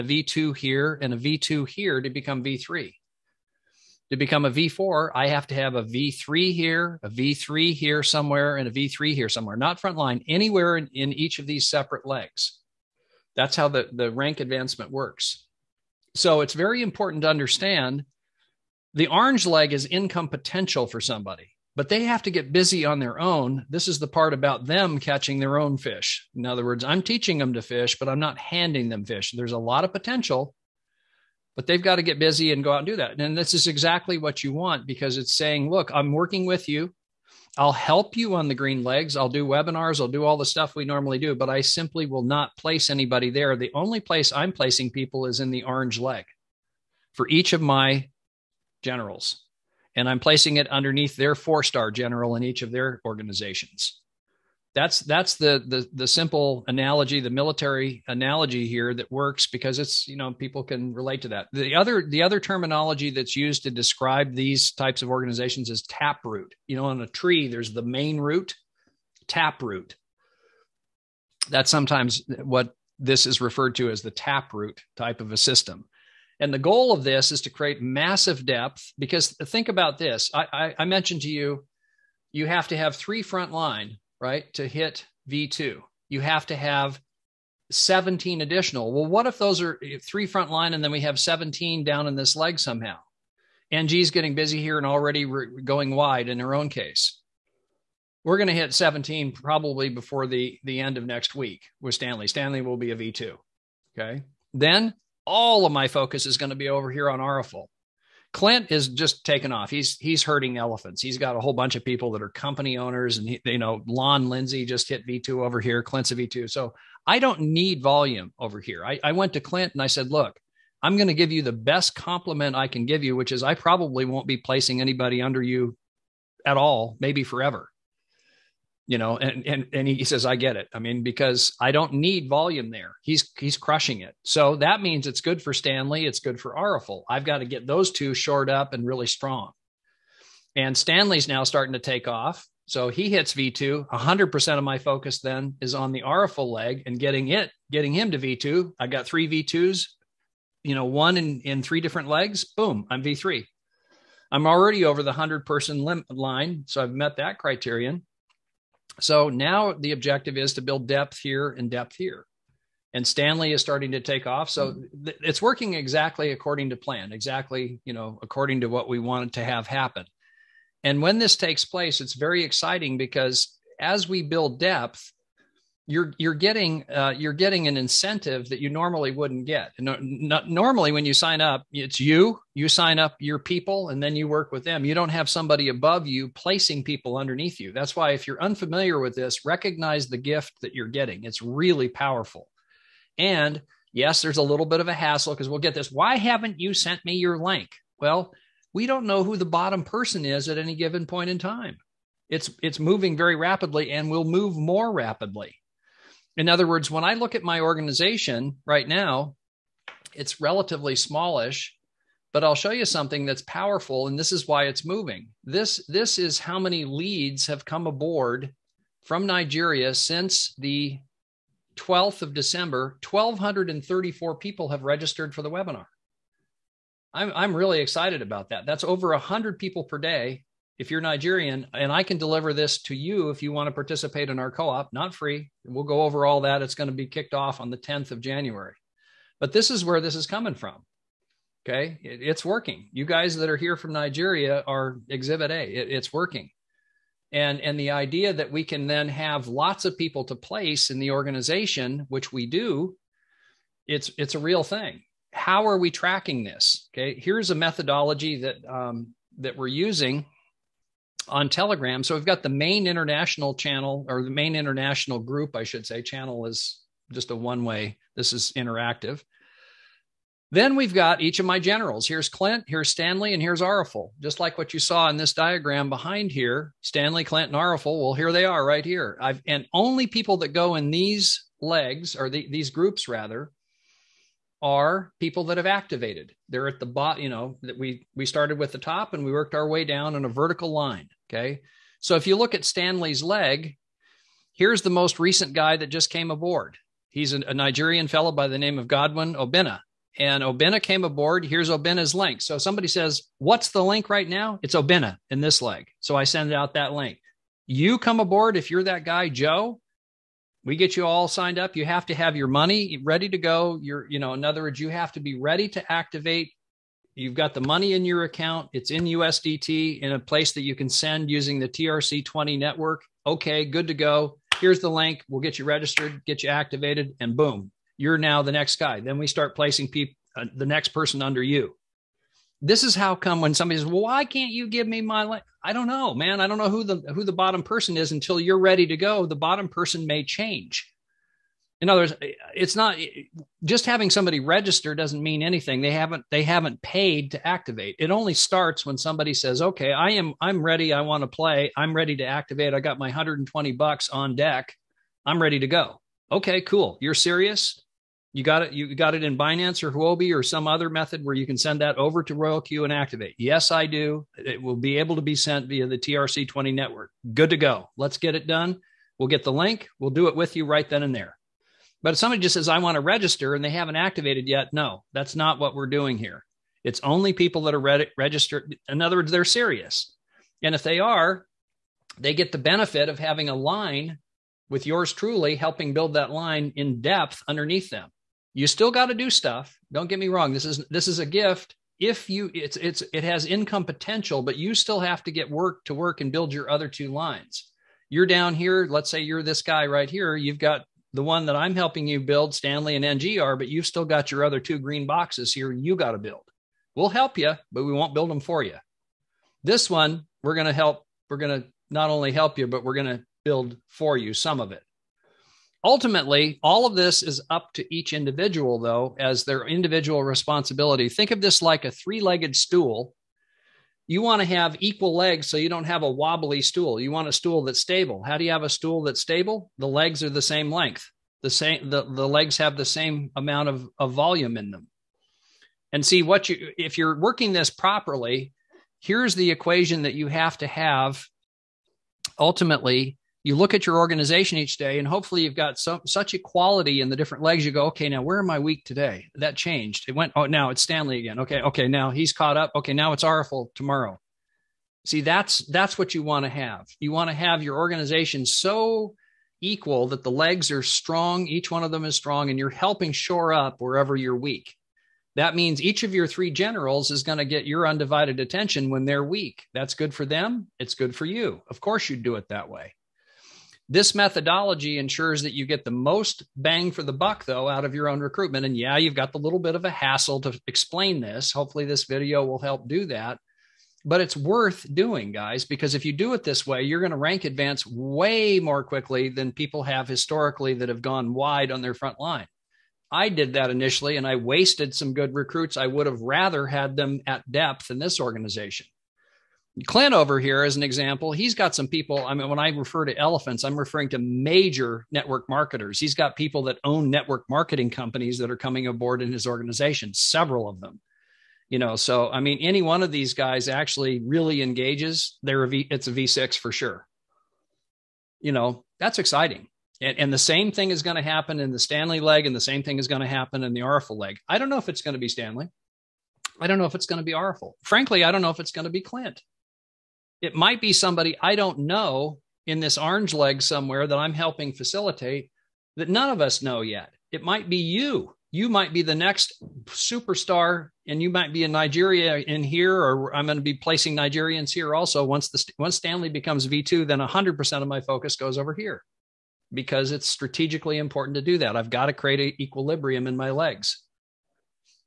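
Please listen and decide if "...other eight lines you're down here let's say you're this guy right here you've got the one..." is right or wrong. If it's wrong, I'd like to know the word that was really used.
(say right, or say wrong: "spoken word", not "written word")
wrong: "two", not "eight".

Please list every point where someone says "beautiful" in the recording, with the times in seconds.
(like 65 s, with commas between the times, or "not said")
not said.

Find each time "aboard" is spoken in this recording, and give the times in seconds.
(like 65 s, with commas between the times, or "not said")
217 s, 296 s, 301 s, 308 s, 508 s.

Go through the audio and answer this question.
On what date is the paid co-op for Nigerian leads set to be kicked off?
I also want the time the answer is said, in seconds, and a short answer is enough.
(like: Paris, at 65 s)
10th of January, at 237 s.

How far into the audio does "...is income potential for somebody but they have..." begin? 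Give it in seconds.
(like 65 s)
19 s.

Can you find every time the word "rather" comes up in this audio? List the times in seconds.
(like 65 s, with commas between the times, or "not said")
283 s, 496 s.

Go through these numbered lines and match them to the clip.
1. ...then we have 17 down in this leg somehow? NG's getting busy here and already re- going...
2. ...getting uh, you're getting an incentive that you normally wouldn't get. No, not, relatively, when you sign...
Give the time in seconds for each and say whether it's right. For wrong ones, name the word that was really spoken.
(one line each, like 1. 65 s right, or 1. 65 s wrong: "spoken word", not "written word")
1. 90 s right
2. 176 s wrong: "normally", not "relatively".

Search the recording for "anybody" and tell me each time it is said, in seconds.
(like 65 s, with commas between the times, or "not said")
42 s, 124 s.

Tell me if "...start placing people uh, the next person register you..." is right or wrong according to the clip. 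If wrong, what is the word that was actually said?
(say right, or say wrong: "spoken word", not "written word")
wrong: "under", not "register".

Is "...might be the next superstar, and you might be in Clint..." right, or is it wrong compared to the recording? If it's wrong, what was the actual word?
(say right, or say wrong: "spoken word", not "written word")
wrong: "Nigeria", not "Clint".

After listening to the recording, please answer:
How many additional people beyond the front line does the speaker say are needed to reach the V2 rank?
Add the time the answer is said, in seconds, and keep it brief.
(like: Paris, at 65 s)
17, at 87 s.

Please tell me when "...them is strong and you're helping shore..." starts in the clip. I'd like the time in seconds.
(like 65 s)
461 s.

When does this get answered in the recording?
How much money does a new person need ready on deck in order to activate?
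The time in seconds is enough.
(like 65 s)
353 s.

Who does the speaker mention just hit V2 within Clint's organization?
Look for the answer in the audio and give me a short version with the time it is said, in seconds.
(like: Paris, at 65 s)
Lon Lindsay, at 113 s.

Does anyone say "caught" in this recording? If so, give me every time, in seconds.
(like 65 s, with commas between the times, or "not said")
452 s.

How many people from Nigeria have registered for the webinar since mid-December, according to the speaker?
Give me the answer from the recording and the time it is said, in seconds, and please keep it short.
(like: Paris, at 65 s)
1,234, at 223 s.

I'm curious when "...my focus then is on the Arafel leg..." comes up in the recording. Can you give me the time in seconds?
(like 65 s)
144 s.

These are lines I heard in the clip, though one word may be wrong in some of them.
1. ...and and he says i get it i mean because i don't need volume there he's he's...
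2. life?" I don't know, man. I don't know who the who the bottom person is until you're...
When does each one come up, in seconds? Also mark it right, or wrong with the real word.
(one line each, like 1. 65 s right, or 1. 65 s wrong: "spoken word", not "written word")
1. 129 s right
2. 335 s right.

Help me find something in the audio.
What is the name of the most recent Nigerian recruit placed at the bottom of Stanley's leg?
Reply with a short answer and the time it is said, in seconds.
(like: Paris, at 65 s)
Godwin Obina, at 298 s.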